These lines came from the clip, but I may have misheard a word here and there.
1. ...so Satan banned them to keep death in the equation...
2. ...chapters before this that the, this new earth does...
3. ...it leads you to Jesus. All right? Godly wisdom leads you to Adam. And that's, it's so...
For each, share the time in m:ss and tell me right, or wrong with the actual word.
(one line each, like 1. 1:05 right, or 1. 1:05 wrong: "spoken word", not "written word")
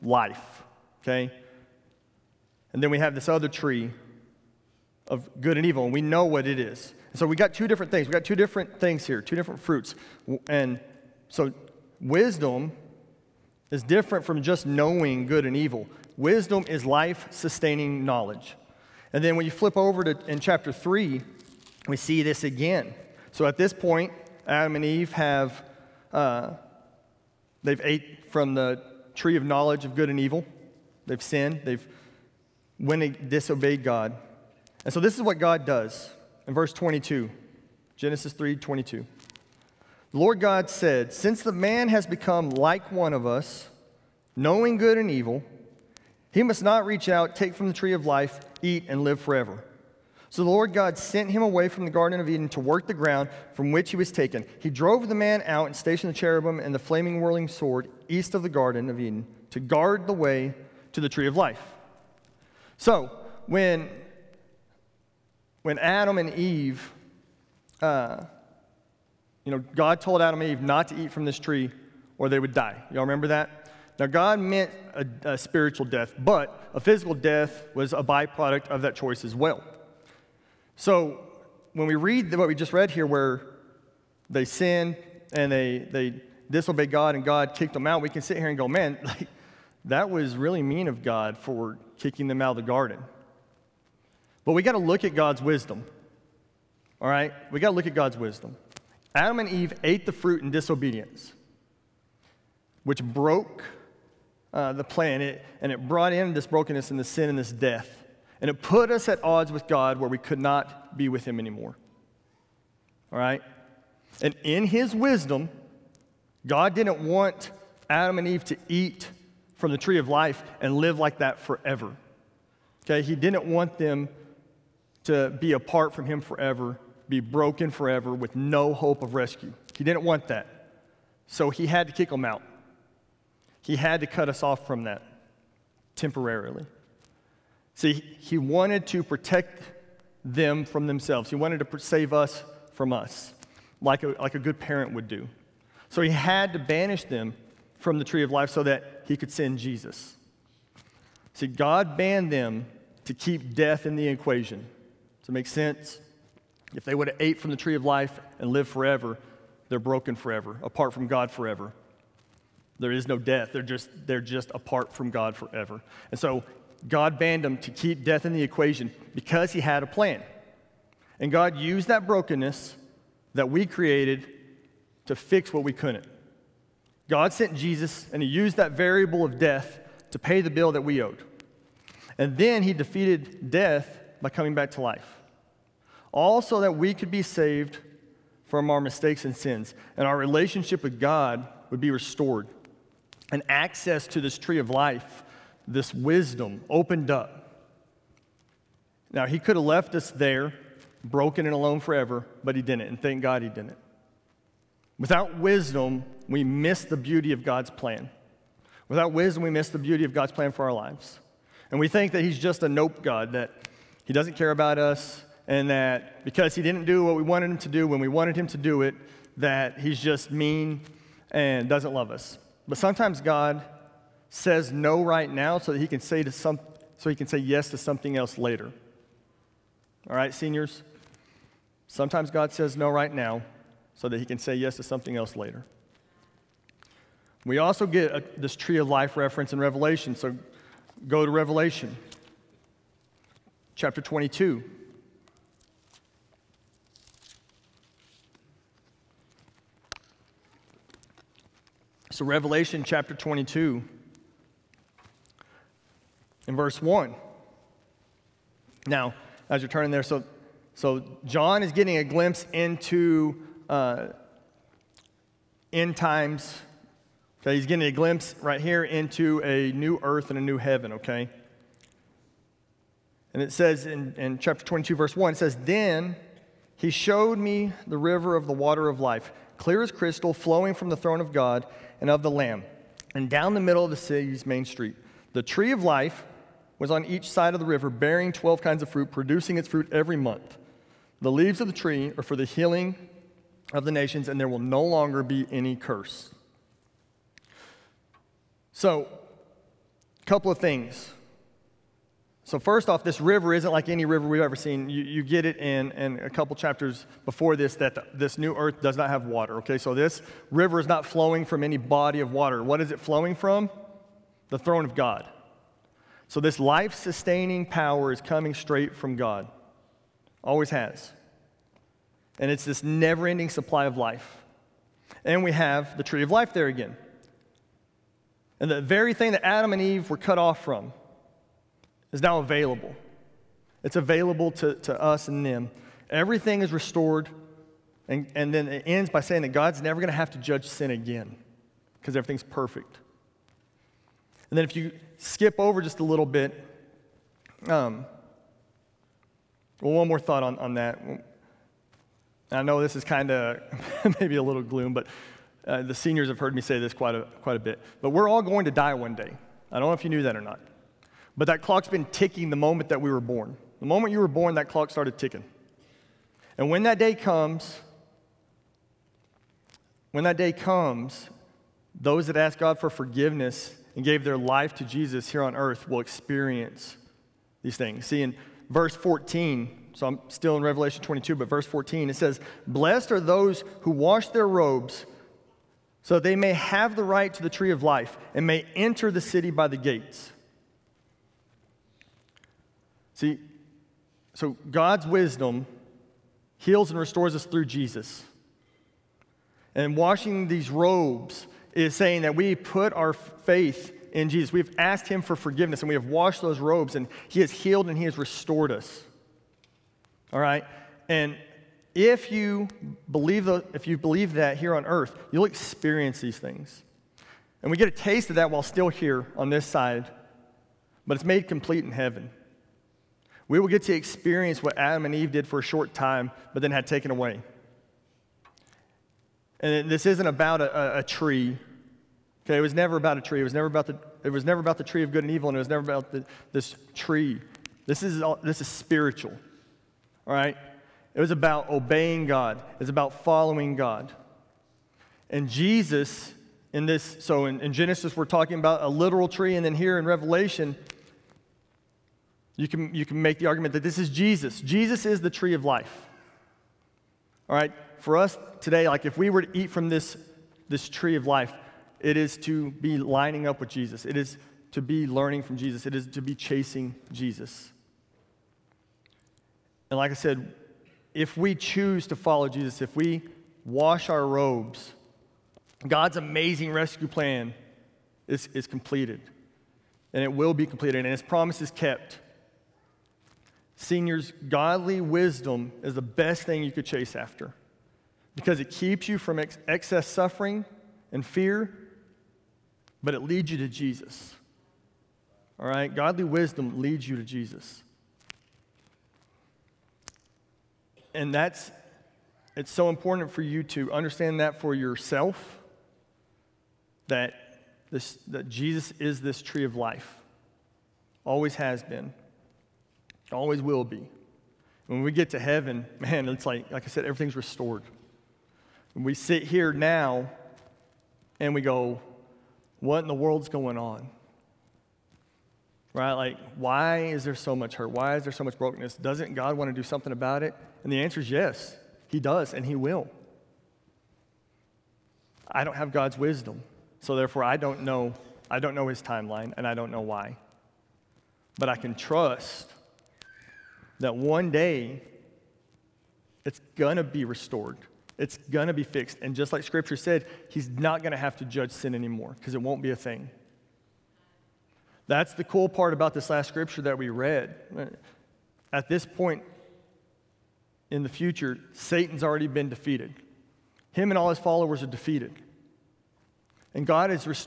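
1. 2:46 wrong: "God", not "Satan"
2. 5:06 right
3. 8:13 wrong: "Jesus", not "Adam".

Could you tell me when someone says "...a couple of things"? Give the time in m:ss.
5:00.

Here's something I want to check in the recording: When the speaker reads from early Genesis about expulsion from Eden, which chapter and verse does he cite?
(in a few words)
Genesis 3:22.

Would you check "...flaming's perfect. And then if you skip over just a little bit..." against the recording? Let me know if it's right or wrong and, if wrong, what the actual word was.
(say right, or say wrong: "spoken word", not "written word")
wrong: "everything", not "flaming".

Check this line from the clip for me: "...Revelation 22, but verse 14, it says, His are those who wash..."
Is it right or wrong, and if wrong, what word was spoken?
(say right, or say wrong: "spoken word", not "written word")
wrong: "Blessed", not "His".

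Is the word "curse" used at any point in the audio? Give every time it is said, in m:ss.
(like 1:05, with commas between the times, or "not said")
4:55.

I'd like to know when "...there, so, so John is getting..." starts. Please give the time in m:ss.
4:19.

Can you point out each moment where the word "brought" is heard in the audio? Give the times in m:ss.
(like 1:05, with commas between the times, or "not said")
1:45.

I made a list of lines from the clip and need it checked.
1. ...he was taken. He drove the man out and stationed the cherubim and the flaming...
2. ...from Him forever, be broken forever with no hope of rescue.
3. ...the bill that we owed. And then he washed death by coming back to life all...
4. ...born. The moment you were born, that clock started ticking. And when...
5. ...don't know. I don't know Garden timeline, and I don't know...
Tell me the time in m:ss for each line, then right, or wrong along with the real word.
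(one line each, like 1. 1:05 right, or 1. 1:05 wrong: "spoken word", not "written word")
1. 0:53 right
2. 2:05 right
3. 3:00 wrong: "defeated", not "washed"
4. 6:03 right
5. 8:57 wrong: "His", not "Garden".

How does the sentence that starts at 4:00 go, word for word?
So go to Revelation chapter 22.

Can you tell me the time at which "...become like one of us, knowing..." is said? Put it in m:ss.
0:42.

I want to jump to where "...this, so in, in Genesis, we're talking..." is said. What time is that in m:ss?
7:26.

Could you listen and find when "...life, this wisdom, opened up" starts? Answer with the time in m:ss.
3:14.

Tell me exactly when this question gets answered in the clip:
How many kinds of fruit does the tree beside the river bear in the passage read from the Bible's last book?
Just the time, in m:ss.
4:48.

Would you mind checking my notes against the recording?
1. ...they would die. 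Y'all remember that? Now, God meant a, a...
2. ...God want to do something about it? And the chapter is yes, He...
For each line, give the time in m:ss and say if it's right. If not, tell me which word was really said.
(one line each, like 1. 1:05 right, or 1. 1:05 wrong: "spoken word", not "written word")
1. 1:12 right
2. 8:49 wrong: "answer", not "chapter".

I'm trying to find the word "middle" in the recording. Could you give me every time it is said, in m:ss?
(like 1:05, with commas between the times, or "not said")
4:43.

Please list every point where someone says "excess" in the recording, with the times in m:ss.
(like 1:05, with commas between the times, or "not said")
8:09.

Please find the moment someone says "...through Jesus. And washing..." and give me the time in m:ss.
6:37.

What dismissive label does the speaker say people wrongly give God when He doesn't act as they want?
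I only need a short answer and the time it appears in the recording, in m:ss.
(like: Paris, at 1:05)
a nope God, at 3:32.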